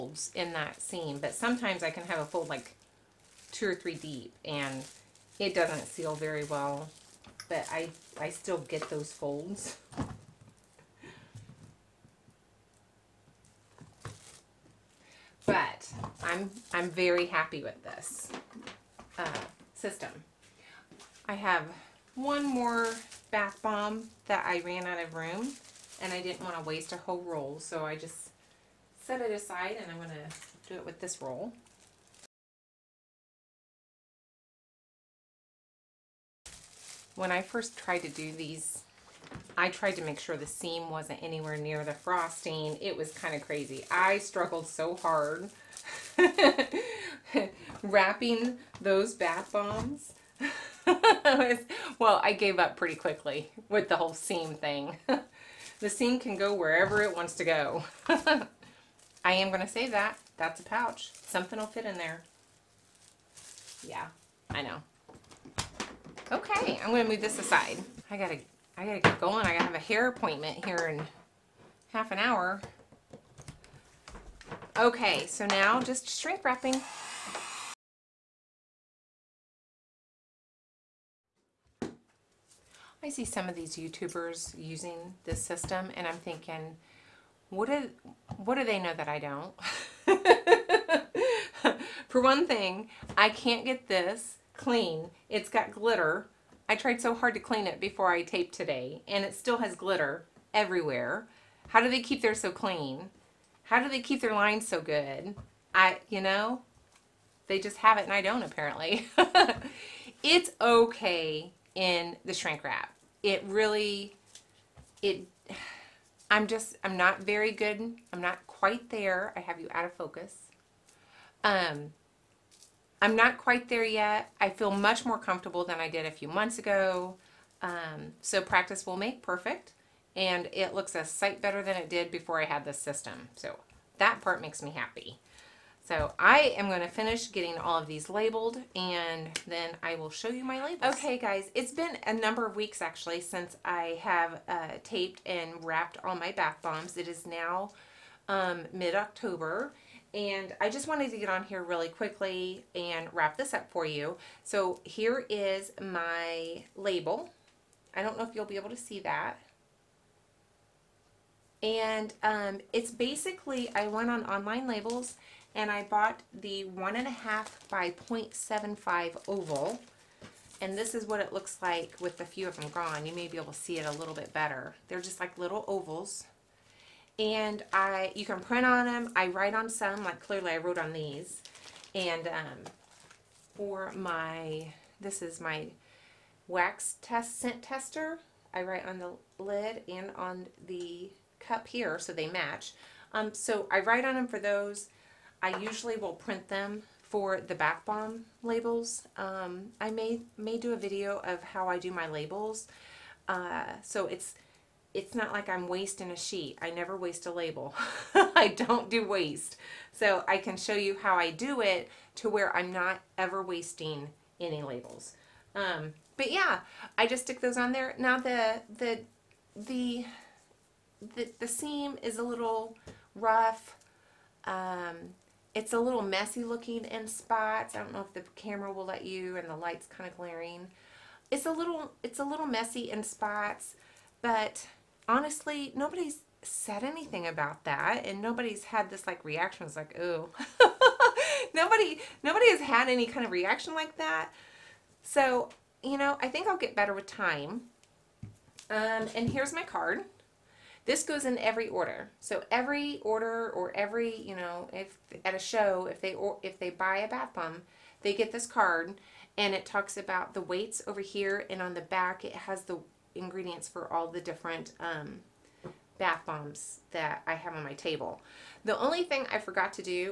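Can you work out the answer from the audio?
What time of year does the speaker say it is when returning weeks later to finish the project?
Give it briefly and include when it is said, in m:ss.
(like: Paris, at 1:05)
mid-October, at 2:28.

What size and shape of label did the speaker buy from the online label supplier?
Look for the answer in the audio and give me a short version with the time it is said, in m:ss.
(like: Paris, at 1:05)
1.5 by 0.75 oval, at 2:46.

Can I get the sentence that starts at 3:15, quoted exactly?
I usually will print them for the bath bomb labels.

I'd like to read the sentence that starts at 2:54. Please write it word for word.
They're just like little ovals and I you can print on them.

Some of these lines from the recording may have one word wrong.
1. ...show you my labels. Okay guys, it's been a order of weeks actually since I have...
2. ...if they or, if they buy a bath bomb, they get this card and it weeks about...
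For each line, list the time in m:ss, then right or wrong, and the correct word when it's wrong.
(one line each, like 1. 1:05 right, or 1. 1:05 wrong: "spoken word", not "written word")
1. 2:20 wrong: "number", not "order"
2. 4:15 wrong: "talks", not "weeks".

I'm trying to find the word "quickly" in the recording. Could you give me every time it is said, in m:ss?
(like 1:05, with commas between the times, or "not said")
0:52, 2:31.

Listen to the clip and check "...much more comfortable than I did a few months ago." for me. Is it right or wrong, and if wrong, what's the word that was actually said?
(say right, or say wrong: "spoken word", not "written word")
right.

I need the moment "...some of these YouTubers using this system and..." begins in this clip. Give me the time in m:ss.
1:23.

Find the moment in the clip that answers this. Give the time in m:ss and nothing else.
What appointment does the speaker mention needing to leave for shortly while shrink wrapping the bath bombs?
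1:09.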